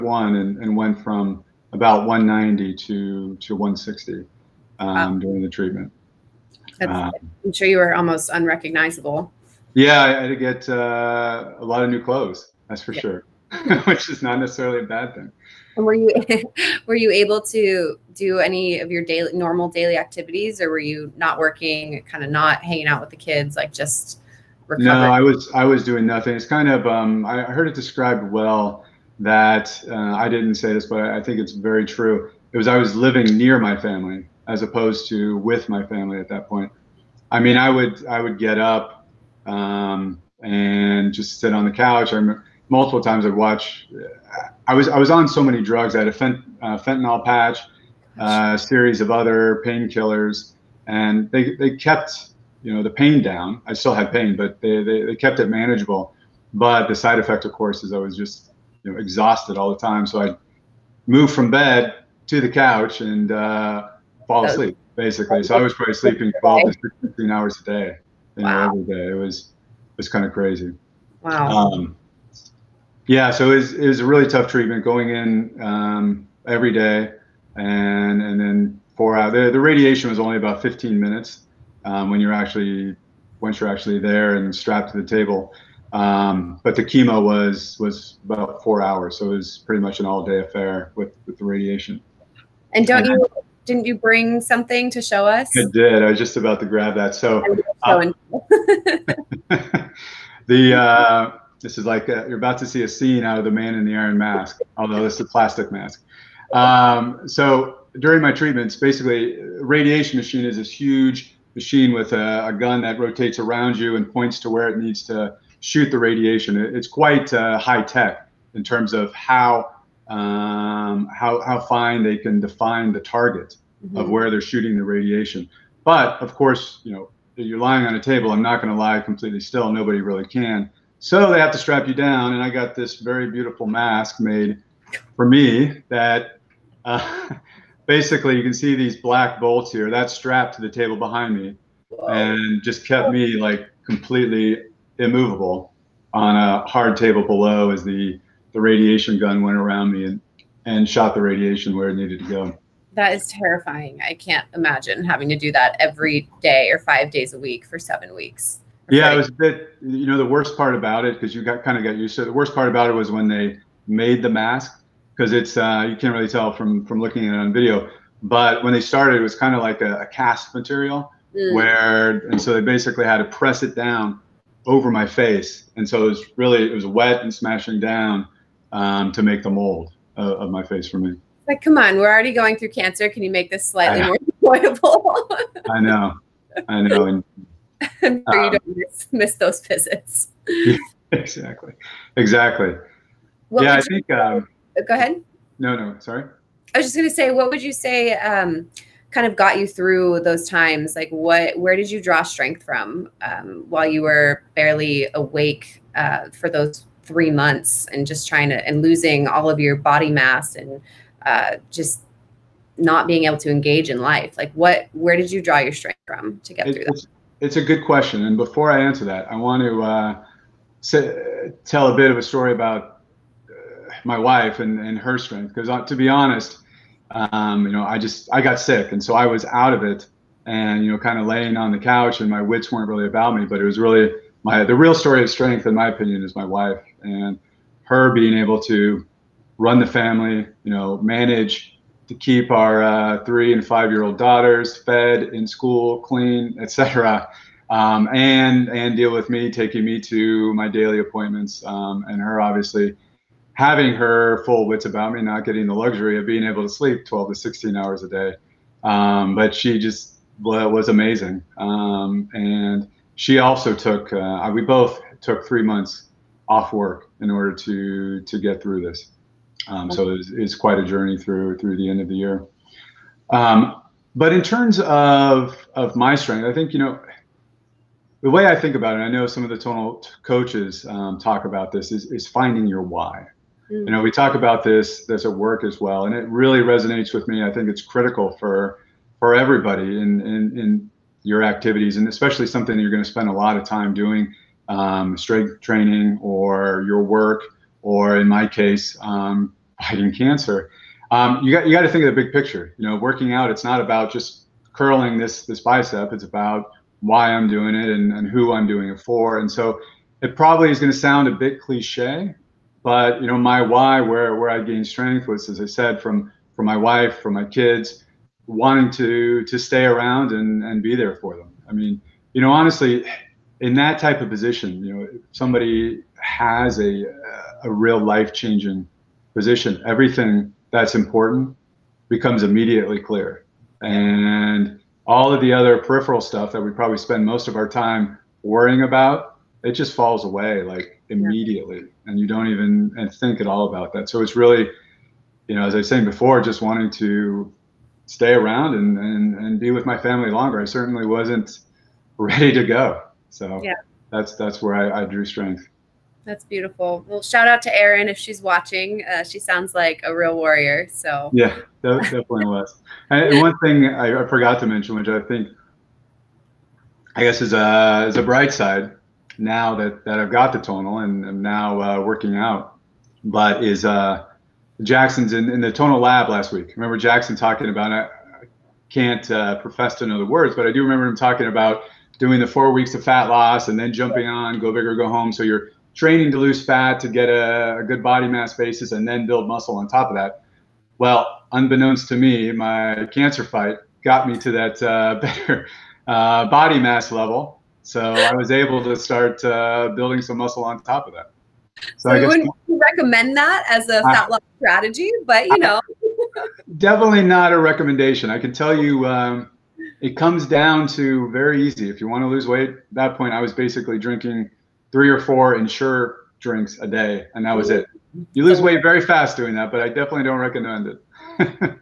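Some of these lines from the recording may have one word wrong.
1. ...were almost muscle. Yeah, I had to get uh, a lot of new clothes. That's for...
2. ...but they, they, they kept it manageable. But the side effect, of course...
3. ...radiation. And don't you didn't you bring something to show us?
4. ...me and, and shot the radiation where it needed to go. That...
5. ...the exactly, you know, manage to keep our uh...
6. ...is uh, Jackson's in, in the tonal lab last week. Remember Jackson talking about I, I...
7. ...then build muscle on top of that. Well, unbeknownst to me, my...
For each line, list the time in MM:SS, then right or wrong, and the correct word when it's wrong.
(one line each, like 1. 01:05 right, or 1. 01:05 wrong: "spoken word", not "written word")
1. 00:07 wrong: "unrecognizable", not "muscle"
2. 00:54 right
3. 01:31 right
4. 02:29 right
5. 03:59 wrong: "family", not "exactly"
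6. 06:13 right
7. 06:29 right.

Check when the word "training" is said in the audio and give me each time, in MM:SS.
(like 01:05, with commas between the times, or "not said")
04:55, 06:25.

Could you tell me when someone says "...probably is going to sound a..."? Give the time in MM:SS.
05:10.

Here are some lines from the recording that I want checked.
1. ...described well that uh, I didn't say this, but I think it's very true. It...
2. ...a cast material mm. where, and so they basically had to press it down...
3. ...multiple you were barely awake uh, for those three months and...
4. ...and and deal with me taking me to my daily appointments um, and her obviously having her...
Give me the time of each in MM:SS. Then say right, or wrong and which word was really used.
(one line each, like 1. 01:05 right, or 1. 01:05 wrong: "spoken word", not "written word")
1. 00:27 right
2. 02:50 right
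3. 03:23 wrong: "while", not "multiple"
4. 04:08 right.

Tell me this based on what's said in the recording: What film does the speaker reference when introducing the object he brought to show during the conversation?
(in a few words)
The Man in the Iron Mask.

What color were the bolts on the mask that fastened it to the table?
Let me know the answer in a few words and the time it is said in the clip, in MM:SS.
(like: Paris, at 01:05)
black, at 02:18.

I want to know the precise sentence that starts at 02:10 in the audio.
So they have to strap you down.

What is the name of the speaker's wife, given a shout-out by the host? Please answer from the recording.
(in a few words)
Erin.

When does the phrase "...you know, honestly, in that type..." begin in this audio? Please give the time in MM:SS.
05:22.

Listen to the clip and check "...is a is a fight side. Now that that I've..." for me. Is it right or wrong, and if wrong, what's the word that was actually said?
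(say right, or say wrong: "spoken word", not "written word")
wrong: "bright", not "fight".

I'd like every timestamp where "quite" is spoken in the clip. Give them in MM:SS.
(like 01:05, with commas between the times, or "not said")
01:56, 04:30.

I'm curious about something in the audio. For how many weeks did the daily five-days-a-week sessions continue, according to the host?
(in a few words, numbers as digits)
7.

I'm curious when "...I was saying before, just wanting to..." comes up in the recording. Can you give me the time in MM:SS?
05:45.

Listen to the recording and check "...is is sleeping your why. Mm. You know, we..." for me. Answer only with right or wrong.
wrong.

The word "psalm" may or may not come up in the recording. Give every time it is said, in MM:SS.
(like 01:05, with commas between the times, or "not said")
not said.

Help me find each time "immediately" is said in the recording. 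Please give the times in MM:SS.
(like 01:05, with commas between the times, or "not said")
05:32, 05:41.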